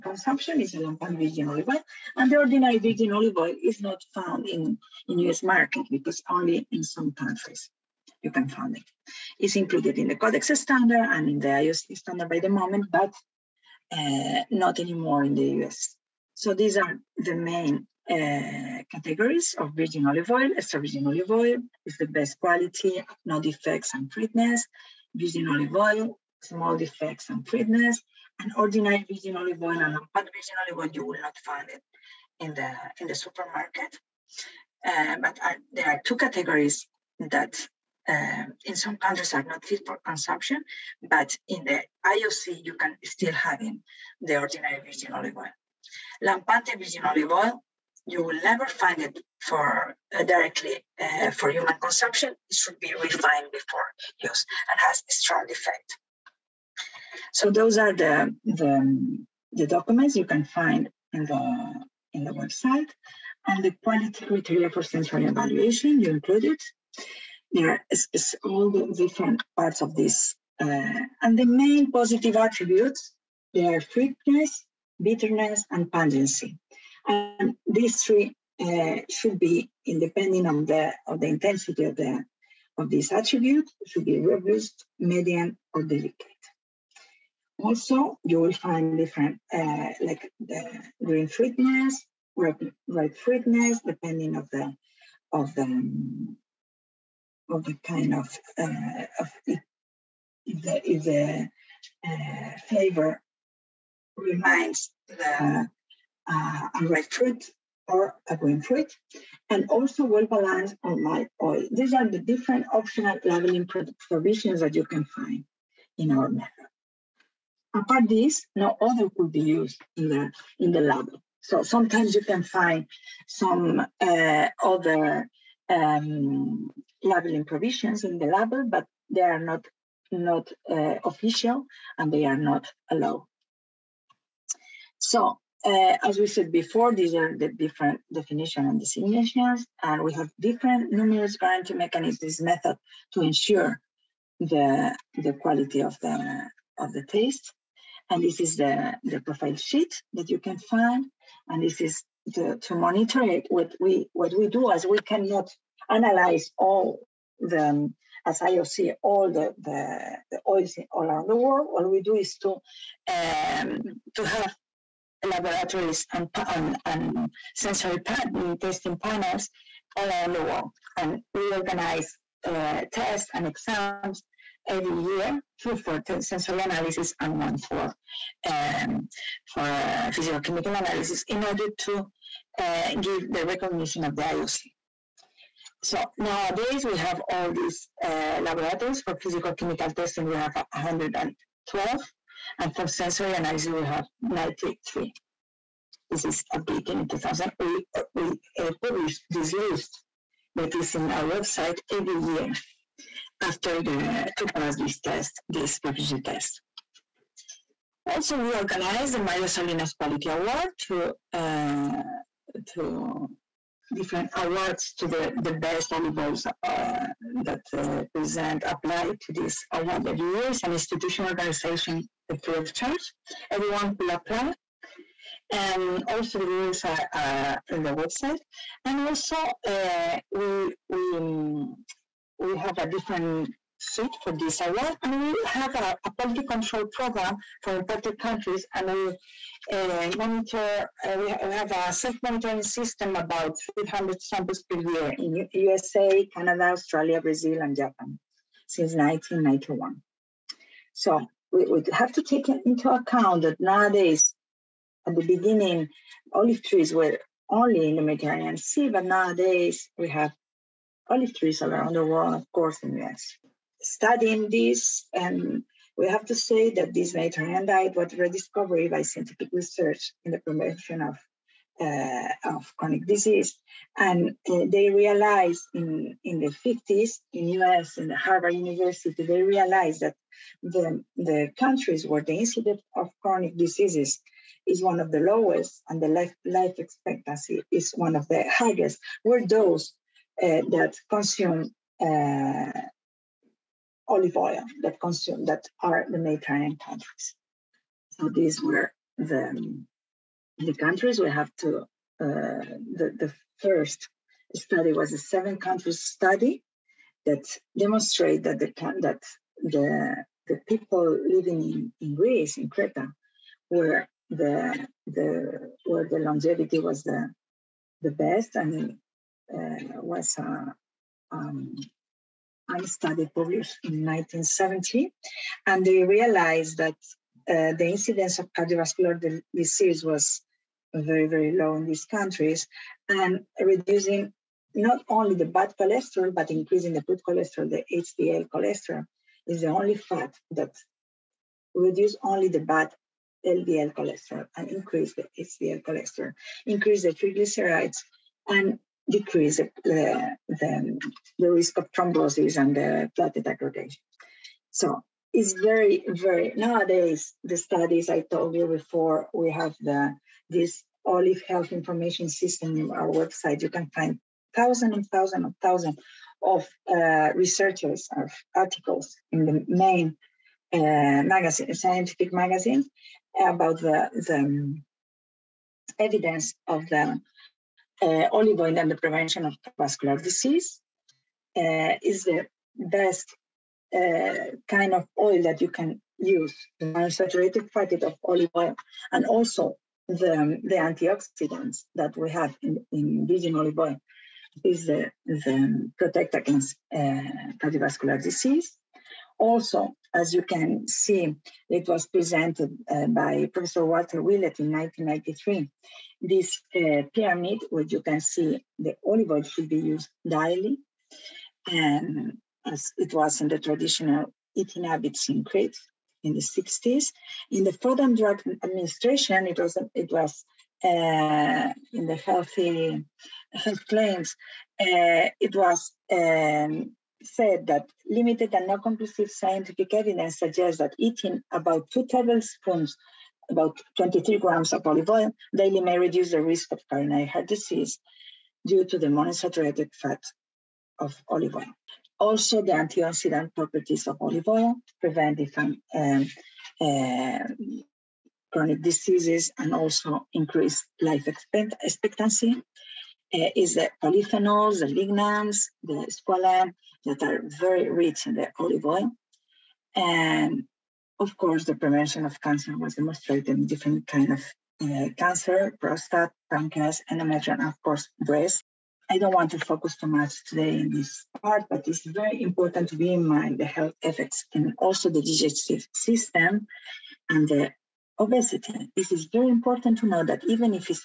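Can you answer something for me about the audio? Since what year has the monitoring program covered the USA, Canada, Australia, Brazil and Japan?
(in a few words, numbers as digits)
1991.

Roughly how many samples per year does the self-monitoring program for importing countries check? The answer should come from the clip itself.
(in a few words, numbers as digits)
about 300.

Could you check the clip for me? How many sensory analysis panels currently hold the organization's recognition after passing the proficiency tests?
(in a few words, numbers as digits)
93.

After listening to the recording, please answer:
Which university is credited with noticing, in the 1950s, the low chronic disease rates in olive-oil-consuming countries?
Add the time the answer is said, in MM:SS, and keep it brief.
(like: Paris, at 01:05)
Harvard University, at 04:38.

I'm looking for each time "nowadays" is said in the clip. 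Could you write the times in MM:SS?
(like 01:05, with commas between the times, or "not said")
03:06, 04:13, 04:19, 05:56.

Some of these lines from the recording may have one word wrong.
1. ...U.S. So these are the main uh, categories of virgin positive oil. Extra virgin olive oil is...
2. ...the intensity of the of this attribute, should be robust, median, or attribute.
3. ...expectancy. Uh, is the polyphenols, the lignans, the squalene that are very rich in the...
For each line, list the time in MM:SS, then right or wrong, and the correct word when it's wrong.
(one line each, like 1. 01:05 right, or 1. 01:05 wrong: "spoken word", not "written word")
1. 00:15 wrong: "olive", not "positive"
2. 01:21 wrong: "delicate", not "attribute"
3. 07:31 right.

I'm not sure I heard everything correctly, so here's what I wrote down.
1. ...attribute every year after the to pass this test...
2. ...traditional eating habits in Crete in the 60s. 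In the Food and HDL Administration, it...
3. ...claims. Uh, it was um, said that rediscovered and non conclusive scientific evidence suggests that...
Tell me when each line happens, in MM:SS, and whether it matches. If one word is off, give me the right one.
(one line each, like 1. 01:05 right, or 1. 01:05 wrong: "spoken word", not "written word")
1. 03:21 wrong: "website", not "attribute"
2. 06:53 wrong: "Drug", not "HDL"
3. 07:03 wrong: "limited", not "rediscovered".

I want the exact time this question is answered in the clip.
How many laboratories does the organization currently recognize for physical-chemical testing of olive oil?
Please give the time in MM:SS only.
03:10.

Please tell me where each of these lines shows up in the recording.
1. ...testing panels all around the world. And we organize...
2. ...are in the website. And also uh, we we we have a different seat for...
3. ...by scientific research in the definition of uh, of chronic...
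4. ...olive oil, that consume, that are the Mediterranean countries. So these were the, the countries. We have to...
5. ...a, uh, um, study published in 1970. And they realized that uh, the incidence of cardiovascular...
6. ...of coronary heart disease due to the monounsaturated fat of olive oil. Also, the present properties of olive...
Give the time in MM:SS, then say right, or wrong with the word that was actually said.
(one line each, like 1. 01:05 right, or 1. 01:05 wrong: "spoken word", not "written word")
1. 02:48 right
2. 03:47 right
3. 04:28 wrong: "promotion", not "definition"
4. 04:54 right
5. 05:20 right
6. 07:16 wrong: "antioxidant", not "present".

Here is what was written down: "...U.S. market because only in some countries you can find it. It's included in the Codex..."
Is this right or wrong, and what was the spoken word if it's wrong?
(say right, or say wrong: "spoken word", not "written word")
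right.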